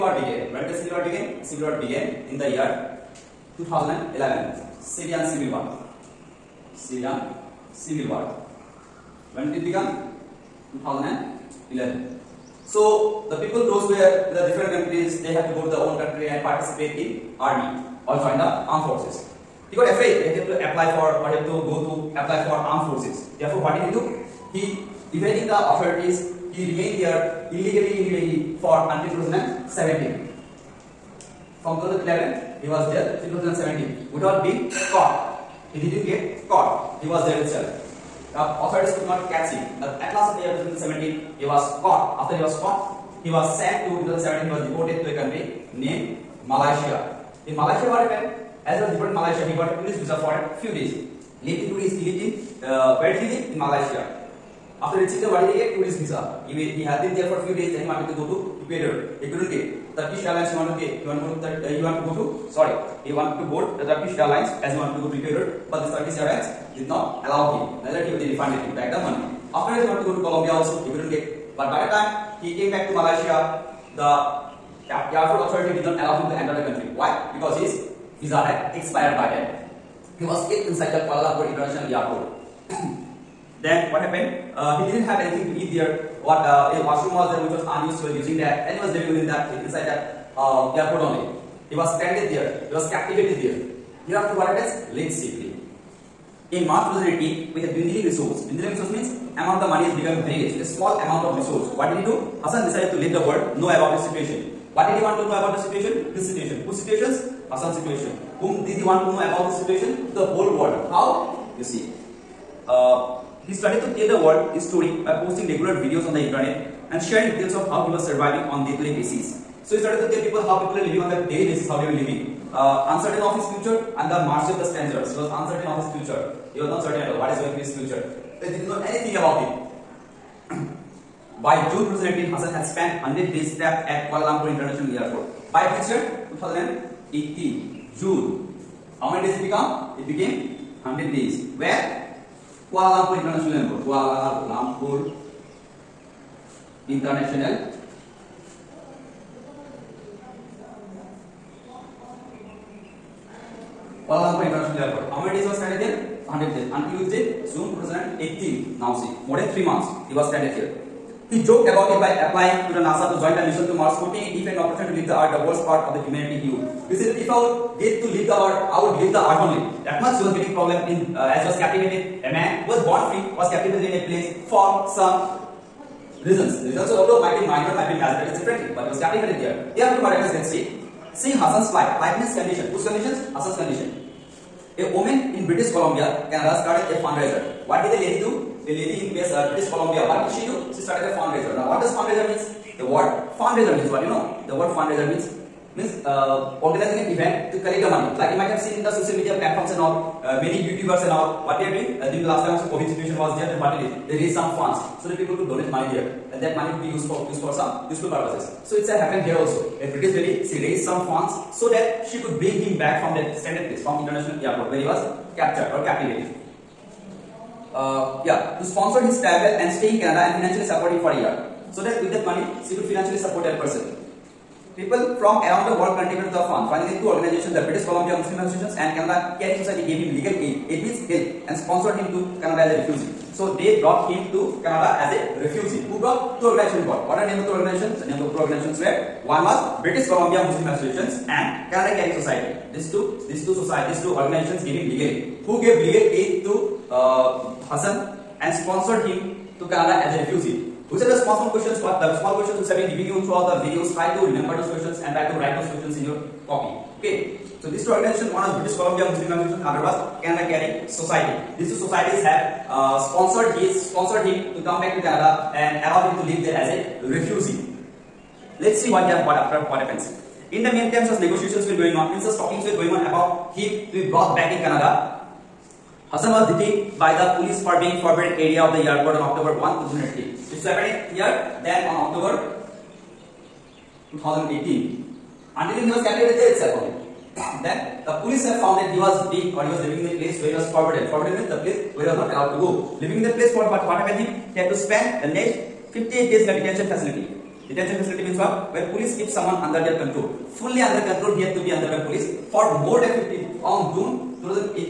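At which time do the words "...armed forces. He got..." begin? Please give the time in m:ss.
0:18.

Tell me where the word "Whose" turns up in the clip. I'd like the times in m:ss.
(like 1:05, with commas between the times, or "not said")
1:46, 3:02.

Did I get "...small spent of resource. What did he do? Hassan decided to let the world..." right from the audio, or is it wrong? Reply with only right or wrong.
wrong.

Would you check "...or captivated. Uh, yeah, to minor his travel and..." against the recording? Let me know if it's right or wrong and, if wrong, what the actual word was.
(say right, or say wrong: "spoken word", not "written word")
wrong: "sponsor", not "minor".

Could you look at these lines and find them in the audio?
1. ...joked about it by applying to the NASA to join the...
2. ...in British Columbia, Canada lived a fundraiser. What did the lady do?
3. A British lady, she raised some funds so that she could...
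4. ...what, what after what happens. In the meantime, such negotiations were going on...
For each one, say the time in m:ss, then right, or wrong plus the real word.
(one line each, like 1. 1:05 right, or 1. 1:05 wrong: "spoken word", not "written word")
1. 2:41 right
2. 3:05 wrong: "started", not "lived"
3. 3:29 right
4. 4:28 right.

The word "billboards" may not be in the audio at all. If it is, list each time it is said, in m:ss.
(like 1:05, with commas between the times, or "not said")
not said.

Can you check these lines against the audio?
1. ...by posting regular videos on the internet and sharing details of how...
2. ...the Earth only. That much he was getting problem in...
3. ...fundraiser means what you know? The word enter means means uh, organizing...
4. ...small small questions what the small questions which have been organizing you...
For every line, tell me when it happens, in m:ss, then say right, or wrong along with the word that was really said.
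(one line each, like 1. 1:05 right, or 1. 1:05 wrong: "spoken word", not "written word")
1. 1:55 right
2. 2:49 right
3. 3:13 wrong: "fundraiser", not "enter"
4. 4:11 wrong: "giving", not "organizing".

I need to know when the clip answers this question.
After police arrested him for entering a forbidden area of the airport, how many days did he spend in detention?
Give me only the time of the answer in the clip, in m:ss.
4:55.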